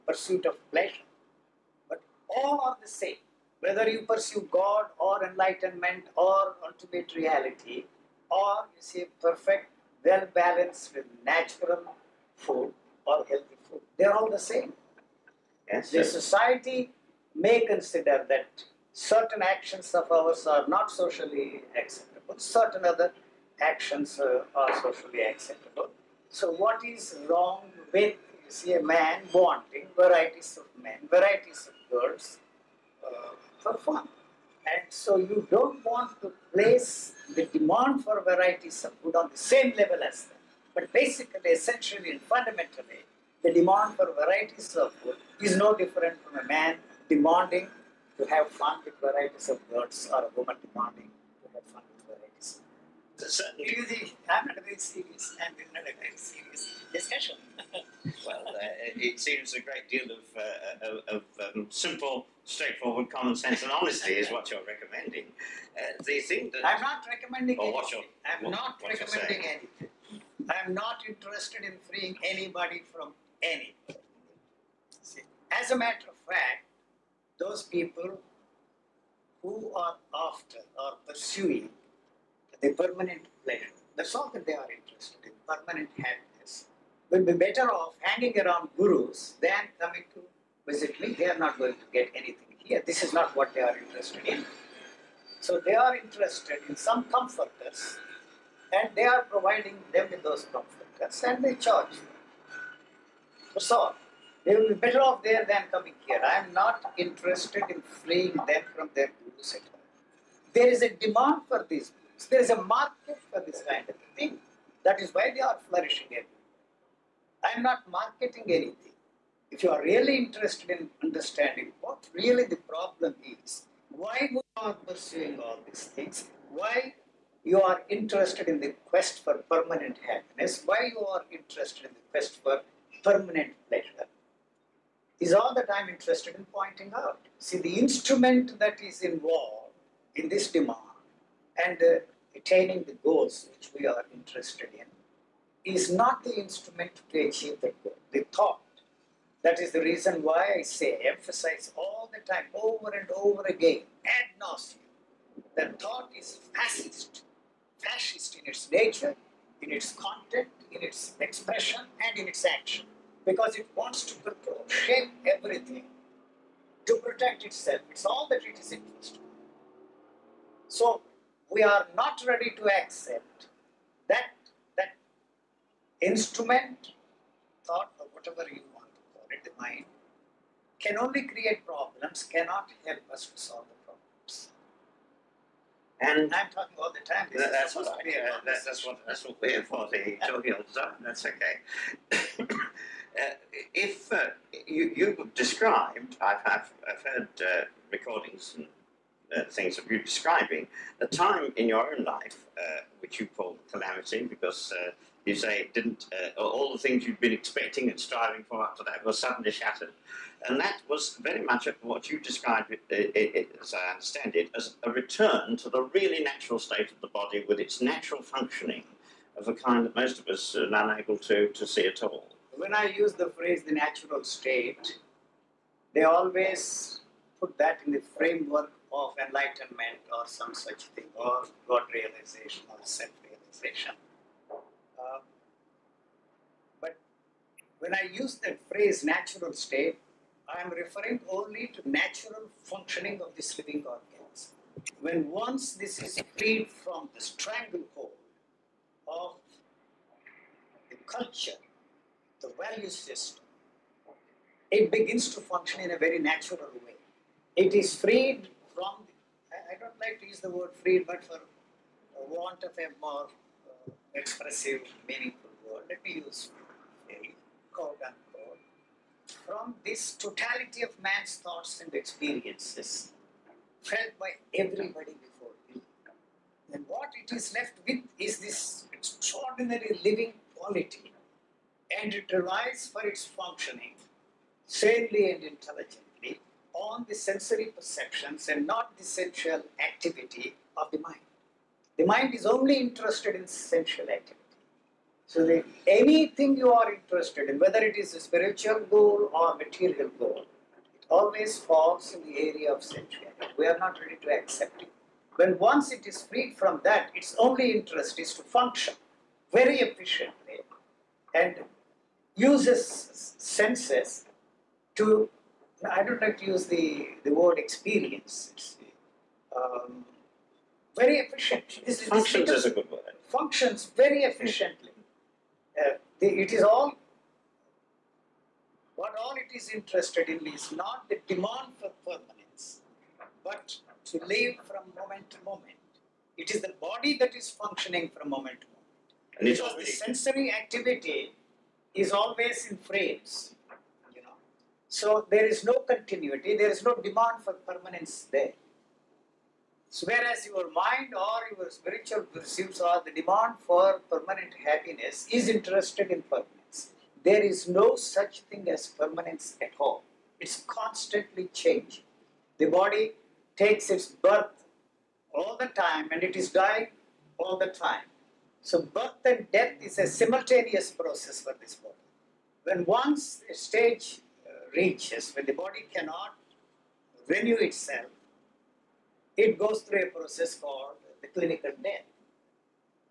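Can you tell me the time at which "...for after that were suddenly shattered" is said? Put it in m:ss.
3:28.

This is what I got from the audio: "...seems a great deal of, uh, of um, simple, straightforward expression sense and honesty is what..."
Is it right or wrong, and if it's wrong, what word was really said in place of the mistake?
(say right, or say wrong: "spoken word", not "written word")
wrong: "common", not "expression".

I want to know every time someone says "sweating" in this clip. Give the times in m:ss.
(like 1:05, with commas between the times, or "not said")
not said.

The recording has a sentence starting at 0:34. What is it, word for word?
And so you don't want to place the demand for varieties of food on the same level as them.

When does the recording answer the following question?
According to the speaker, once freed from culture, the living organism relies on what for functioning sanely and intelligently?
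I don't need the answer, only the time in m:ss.
4:47.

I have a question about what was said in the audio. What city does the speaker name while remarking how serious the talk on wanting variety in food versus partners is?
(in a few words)
Ahmedabad.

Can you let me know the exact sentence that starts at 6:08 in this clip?
So birth and death is a simultaneous process for this body.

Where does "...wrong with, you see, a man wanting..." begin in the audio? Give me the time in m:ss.
0:27.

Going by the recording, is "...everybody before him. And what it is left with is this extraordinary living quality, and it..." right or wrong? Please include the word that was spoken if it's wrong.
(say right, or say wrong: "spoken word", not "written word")
right.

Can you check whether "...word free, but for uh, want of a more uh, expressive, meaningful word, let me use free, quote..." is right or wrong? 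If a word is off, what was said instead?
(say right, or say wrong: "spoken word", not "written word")
right.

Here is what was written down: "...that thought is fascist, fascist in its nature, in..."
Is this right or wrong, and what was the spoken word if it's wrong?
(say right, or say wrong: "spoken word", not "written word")
right.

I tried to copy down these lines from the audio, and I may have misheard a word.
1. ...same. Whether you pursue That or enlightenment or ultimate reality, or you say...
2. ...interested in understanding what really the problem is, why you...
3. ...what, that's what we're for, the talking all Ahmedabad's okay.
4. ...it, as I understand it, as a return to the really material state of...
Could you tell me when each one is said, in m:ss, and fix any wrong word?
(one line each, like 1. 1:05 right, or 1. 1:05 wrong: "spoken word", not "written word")
1. 0:02 wrong: "God", not "That"
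2. 2:00 right
3. 3:08 wrong: "That", not "Ahmedabad"
4. 3:33 wrong: "natural", not "material".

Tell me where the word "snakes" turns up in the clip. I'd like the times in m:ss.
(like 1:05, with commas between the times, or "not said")
not said.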